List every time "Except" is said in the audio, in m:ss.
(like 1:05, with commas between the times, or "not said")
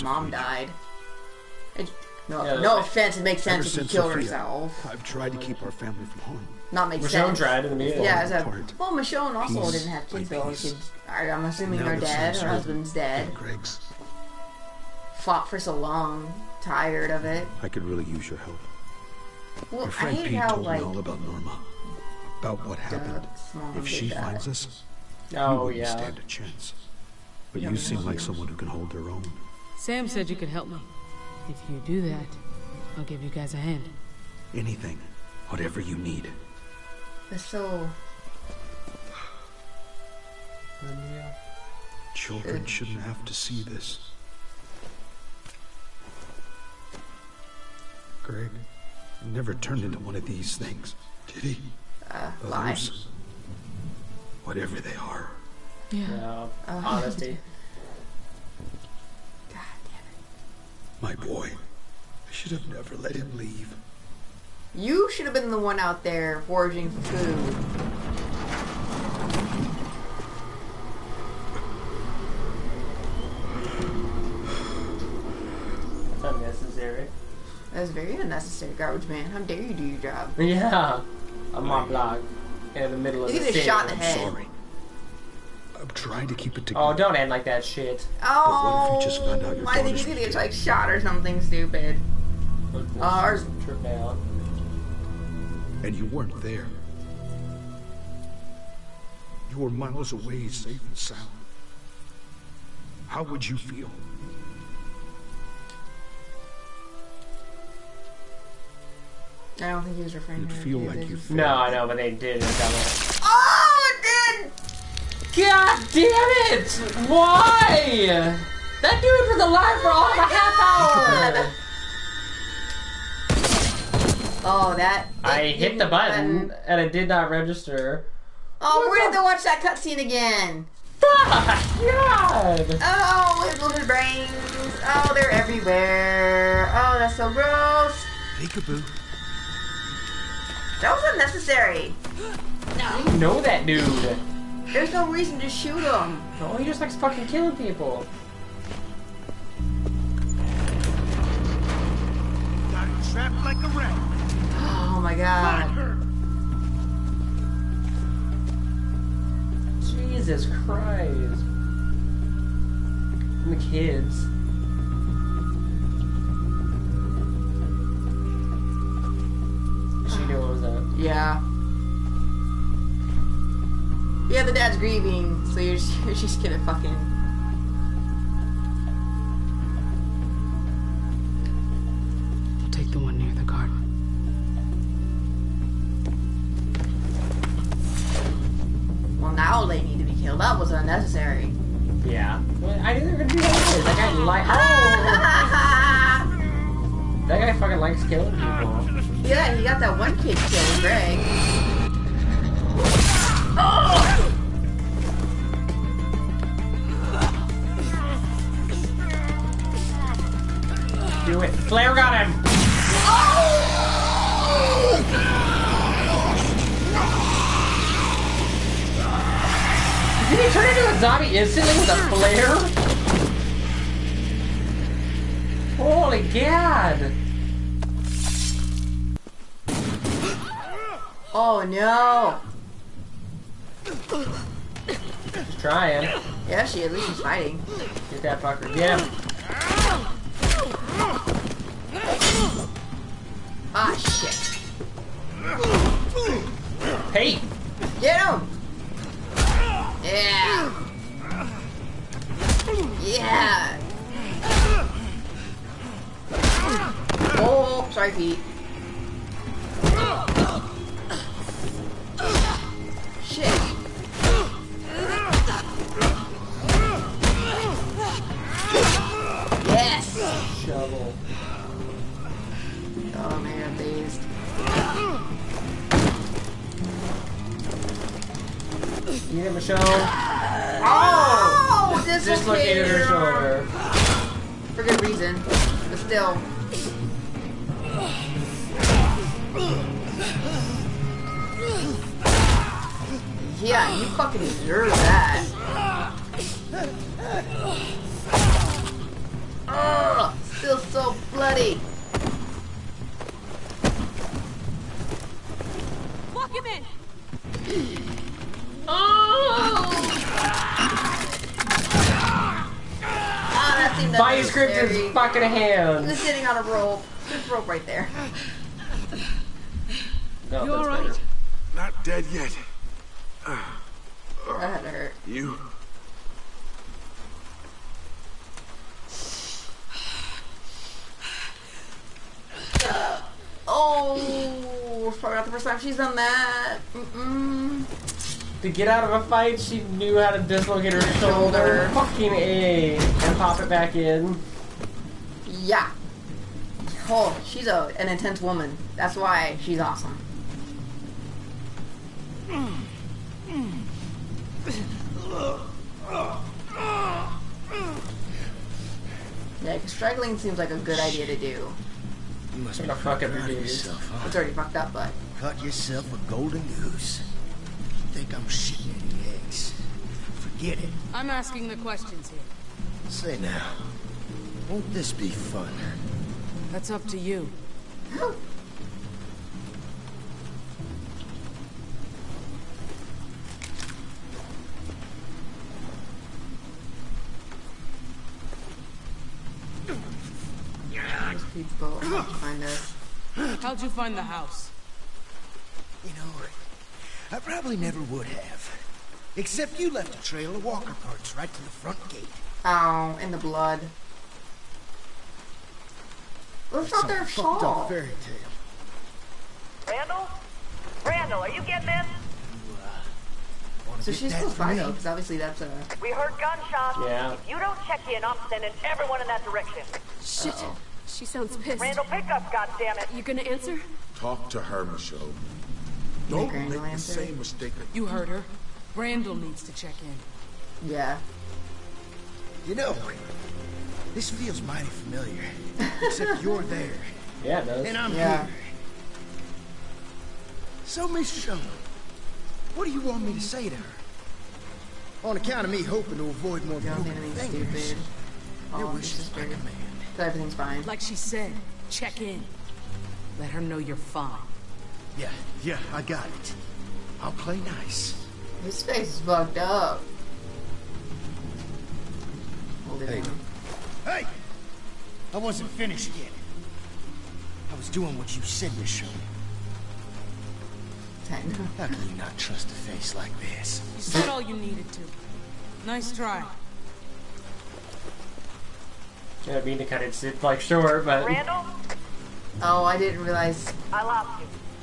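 6:39, 7:16.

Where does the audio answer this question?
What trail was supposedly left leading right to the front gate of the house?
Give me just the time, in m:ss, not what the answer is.
6:40.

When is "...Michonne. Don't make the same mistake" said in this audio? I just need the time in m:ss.
7:04.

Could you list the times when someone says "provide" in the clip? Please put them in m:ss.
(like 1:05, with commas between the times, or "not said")
not said.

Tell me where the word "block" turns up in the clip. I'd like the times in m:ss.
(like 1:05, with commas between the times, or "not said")
1:21.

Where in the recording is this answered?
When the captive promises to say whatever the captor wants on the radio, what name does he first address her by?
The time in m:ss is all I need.
7:21.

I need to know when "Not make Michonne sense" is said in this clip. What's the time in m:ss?
0:06.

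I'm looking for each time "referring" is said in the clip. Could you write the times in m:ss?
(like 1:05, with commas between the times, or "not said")
1:50.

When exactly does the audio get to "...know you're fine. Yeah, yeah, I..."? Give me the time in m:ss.
7:33.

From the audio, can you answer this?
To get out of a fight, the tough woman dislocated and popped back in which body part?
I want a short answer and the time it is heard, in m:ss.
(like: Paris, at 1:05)
Her shoulder, at 5:41.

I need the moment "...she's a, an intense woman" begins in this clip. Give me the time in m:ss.
5:47.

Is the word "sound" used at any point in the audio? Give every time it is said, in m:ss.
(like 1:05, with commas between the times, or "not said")
1:40, 7:01.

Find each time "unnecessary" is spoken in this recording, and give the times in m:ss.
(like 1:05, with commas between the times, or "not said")
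1:18, 2:21, 3:10.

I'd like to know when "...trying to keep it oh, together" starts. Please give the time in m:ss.
1:25.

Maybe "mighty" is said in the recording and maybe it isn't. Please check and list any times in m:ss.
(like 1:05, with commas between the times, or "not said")
7:14.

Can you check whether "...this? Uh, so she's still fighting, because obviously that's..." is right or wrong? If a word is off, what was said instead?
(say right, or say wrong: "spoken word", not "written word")
right.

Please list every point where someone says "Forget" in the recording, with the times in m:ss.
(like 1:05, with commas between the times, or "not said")
6:10.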